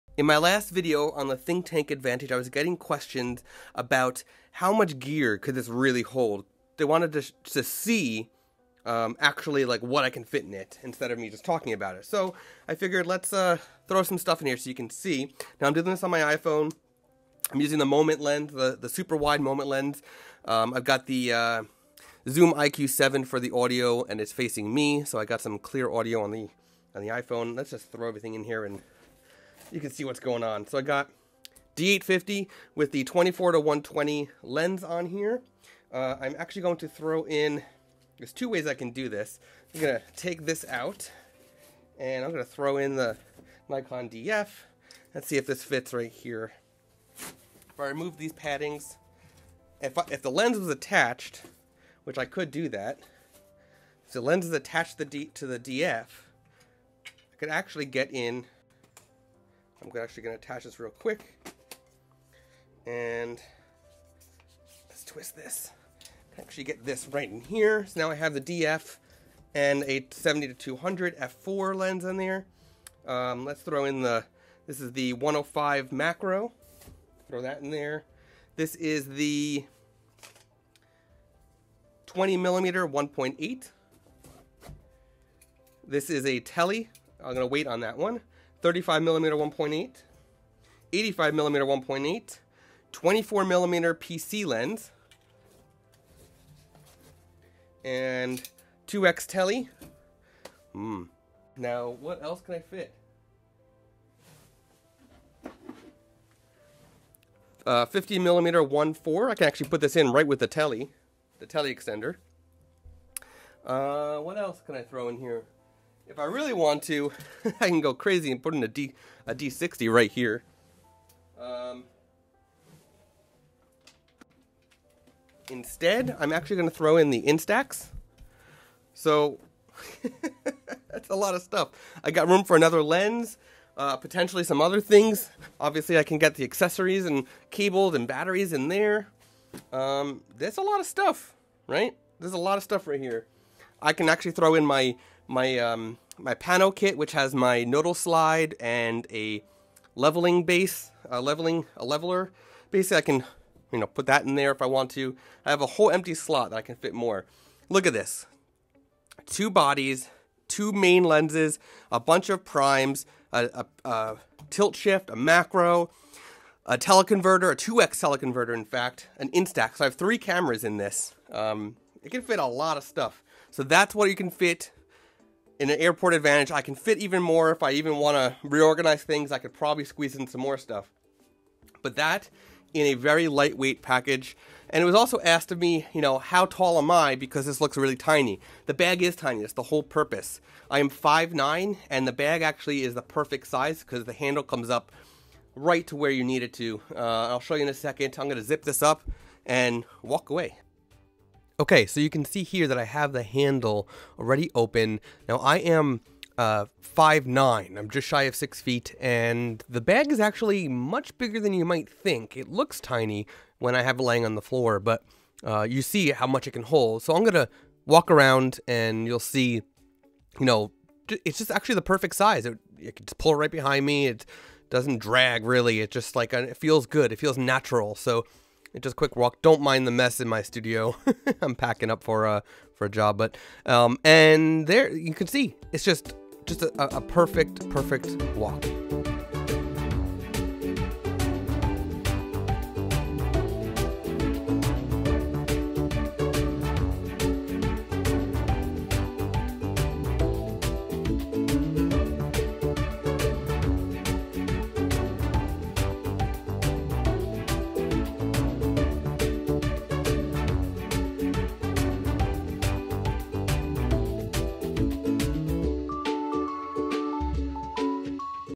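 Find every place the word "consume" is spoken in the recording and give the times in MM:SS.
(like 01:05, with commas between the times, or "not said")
not said.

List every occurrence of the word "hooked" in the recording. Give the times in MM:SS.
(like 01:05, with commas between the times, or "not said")
not said.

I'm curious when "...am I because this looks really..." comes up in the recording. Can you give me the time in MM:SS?
03:06.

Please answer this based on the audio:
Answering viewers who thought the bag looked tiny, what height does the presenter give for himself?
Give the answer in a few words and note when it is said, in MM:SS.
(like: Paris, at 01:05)
5'9, at 03:10.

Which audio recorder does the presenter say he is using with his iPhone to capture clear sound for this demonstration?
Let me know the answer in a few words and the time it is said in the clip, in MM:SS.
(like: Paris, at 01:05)
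Zoom IQ7, at 00:22.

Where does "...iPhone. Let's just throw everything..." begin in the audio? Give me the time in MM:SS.
00:27.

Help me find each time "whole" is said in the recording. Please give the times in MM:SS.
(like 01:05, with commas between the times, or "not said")
02:35, 03:09.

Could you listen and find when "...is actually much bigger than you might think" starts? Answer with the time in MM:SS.
03:30.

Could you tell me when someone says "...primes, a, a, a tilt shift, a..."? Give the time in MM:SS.
02:42.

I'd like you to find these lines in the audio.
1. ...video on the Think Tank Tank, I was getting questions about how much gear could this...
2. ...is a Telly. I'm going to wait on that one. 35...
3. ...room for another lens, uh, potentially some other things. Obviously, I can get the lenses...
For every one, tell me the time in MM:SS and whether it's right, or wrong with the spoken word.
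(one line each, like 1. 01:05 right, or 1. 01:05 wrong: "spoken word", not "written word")
1. 00:00 wrong: "Advantage", not "Tank"
2. 01:26 right
3. 02:12 wrong: "accessories", not "lenses".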